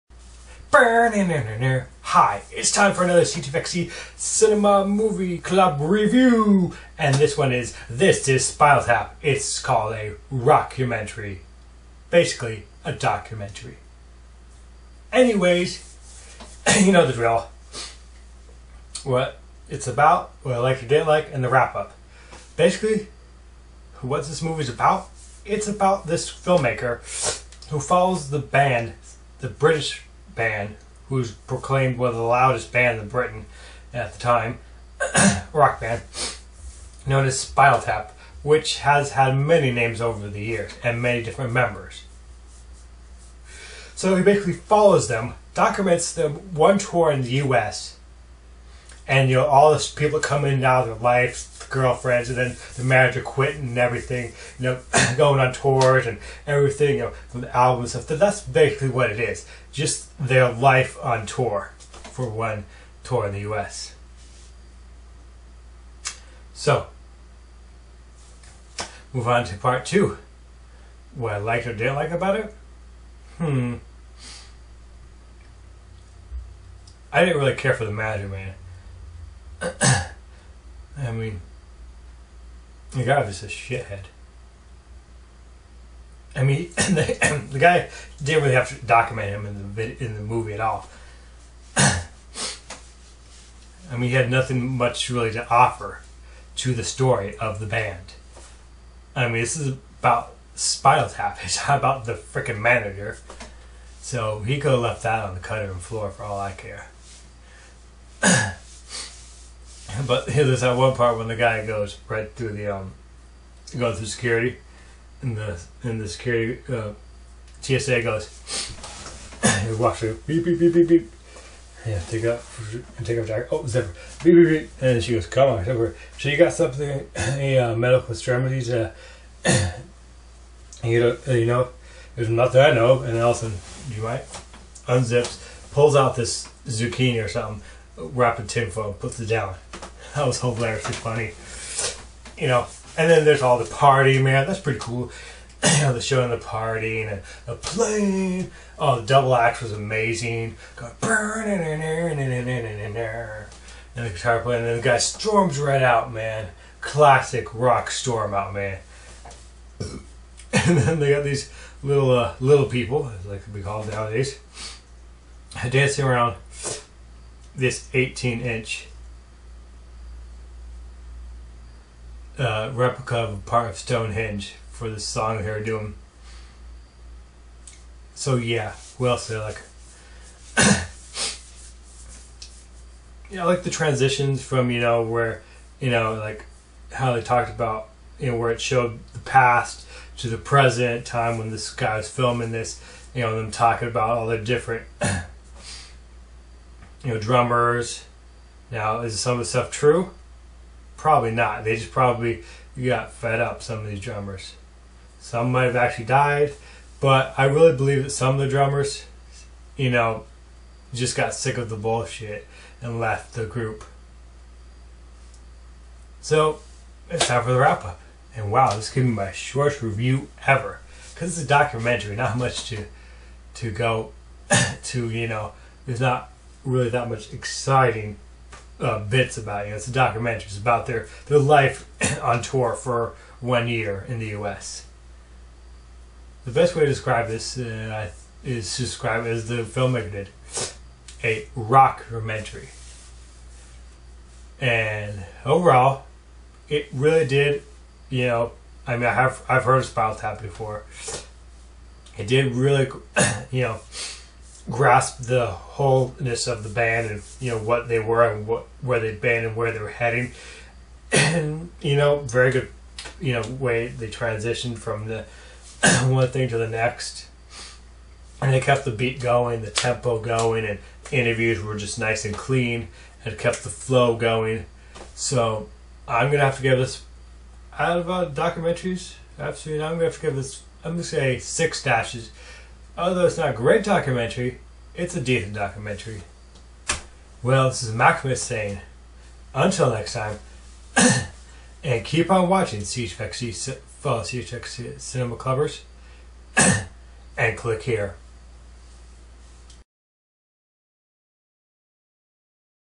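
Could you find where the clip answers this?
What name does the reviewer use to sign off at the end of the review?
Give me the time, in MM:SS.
04:47.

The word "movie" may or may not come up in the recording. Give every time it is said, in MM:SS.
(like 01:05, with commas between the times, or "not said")
00:04, 00:24, 01:30.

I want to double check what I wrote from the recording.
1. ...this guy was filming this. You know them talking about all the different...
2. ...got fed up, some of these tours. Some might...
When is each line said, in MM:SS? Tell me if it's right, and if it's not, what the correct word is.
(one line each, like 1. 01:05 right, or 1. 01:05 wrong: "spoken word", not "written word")
1. 03:11 right
2. 03:22 wrong: "drummers", not "tours".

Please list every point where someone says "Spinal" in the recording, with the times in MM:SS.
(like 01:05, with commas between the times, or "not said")
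00:08, 00:37, 01:40, 04:09.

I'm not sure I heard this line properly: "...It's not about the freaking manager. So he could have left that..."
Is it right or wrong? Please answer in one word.
right.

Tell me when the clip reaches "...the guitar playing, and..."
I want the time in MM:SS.
02:34.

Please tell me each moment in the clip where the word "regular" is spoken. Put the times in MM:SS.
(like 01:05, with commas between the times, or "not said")
not said.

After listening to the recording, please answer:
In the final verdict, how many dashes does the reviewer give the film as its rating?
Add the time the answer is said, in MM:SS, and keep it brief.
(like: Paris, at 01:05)
6 dashes, at 04:41.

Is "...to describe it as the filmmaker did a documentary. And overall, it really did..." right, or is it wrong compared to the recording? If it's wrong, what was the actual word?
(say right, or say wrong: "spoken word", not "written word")
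wrong: "rockumentary", not "documentary".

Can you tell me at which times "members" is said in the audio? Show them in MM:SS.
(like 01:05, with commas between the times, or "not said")
00:41.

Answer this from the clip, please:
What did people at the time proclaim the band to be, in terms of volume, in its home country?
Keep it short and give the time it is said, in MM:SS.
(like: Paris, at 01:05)
loudest bands in Britain, at 00:32.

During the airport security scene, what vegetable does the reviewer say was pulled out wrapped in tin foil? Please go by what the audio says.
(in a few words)
zucchini.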